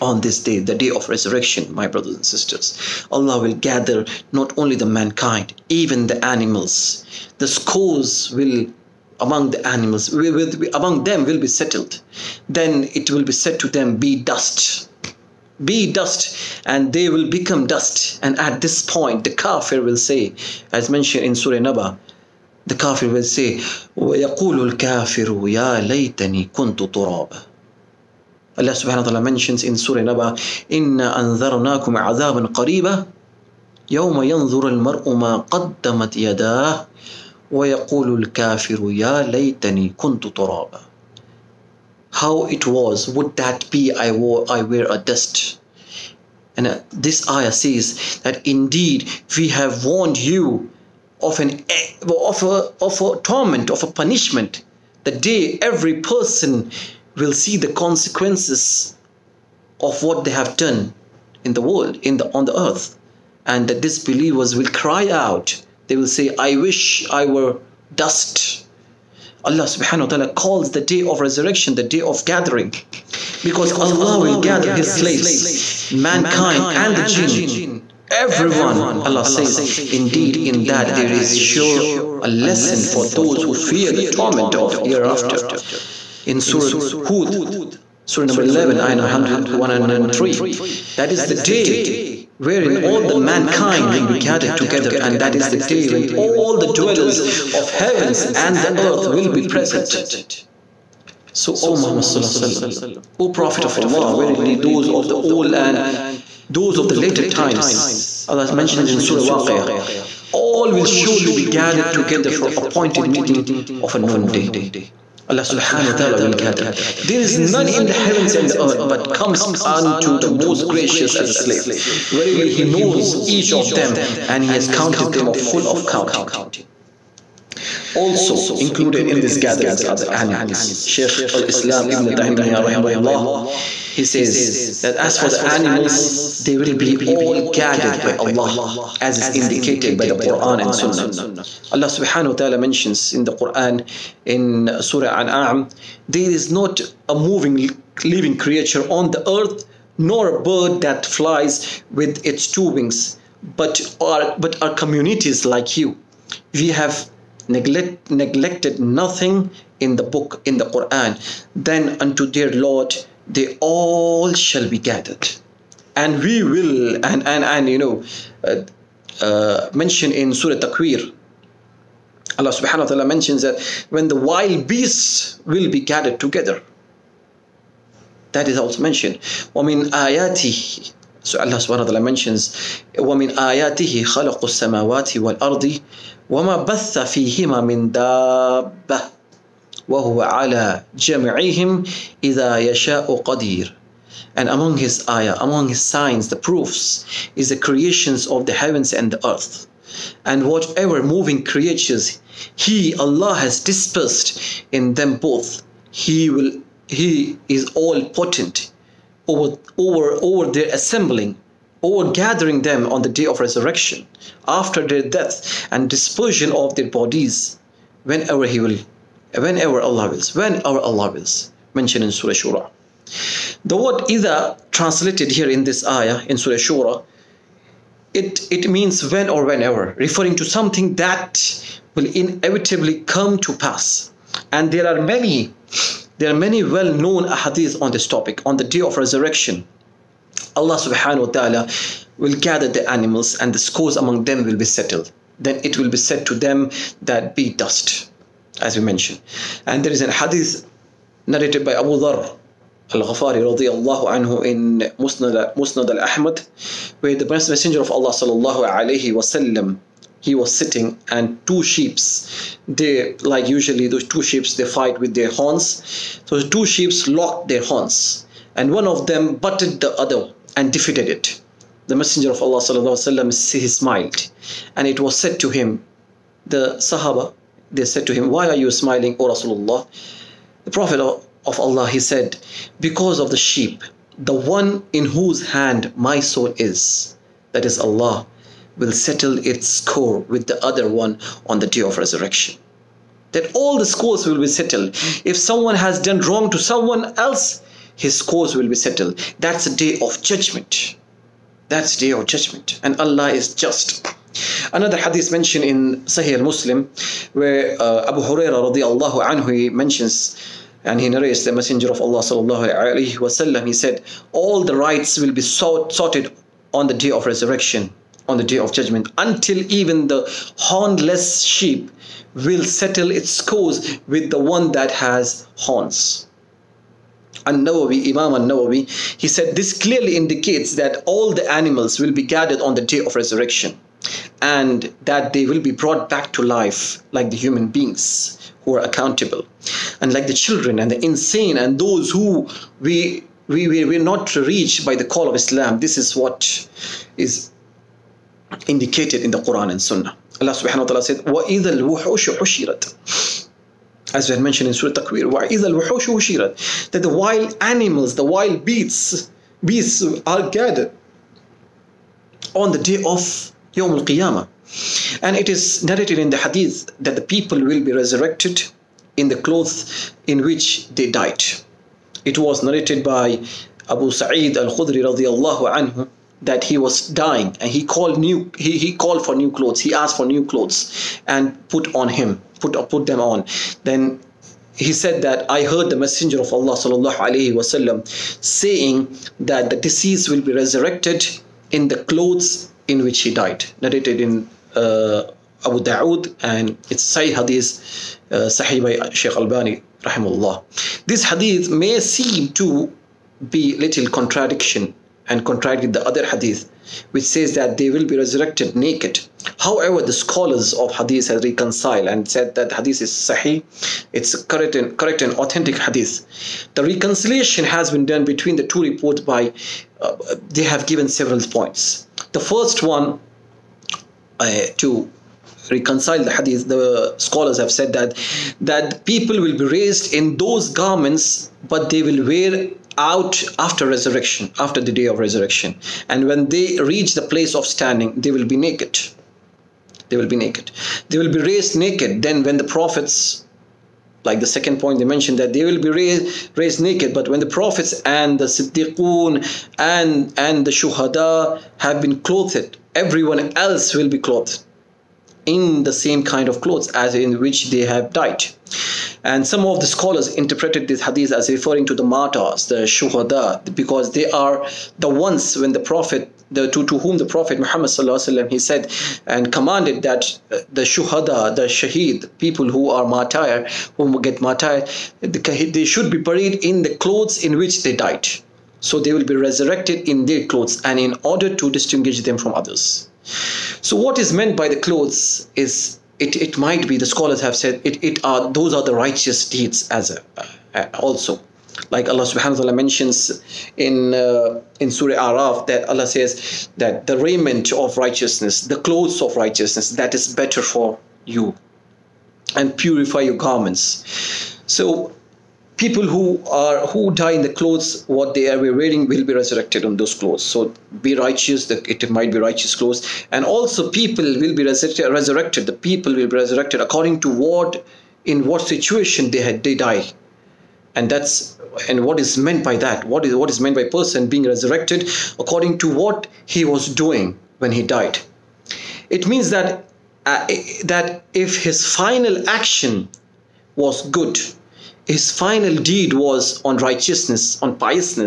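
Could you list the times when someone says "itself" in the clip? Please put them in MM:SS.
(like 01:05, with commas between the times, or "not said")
not said.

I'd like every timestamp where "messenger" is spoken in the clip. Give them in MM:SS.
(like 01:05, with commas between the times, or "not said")
04:17, 04:31, 05:11, 06:25.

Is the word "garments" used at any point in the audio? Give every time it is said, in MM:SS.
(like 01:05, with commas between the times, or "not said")
07:10, 08:23.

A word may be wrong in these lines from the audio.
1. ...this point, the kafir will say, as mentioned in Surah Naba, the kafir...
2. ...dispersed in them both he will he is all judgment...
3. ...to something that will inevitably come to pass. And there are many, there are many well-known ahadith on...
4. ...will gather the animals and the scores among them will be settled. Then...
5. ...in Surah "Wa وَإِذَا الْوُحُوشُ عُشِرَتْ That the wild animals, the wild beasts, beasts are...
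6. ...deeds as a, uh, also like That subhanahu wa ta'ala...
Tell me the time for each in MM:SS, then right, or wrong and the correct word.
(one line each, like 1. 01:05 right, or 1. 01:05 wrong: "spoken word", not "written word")
1. 00:18 right
2. 03:23 wrong: "potent", not "judgment"
3. 03:50 right
4. 04:02 right
5. 05:54 right
6. 08:09 wrong: "Allah", not "That".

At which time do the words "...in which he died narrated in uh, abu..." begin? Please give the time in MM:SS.
06:32.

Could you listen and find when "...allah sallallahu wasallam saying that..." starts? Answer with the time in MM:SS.
06:26.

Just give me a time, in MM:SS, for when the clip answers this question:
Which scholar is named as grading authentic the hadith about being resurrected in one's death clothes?
06:39.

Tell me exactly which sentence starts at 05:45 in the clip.
This is what is indicated in the Quran and Sunnah.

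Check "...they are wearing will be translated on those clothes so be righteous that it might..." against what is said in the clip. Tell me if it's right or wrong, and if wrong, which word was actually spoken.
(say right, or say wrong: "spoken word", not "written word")
wrong: "resurrected", not "translated".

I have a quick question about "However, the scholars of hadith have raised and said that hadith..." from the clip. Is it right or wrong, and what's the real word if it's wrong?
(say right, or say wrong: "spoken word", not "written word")
wrong: "reconciled", not "raised".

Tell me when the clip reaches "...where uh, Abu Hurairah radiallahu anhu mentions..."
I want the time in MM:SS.
05:07.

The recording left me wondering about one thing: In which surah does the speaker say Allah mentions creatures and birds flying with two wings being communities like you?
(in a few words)
Surah An'am.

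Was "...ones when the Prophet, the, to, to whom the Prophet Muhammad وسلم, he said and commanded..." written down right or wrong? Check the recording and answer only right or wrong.
right.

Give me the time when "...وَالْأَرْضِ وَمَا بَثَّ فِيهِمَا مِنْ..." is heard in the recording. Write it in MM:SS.
03:05.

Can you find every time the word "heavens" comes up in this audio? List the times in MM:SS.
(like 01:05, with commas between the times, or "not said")
01:37, 01:57, 03:18.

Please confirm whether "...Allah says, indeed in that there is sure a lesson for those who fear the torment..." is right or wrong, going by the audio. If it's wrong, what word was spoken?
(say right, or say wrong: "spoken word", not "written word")
right.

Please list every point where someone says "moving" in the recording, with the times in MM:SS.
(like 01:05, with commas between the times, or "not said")
02:27, 03:21.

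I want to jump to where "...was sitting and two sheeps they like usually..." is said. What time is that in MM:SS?
04:20.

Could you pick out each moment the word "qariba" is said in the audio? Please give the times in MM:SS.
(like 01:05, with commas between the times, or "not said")
00:32.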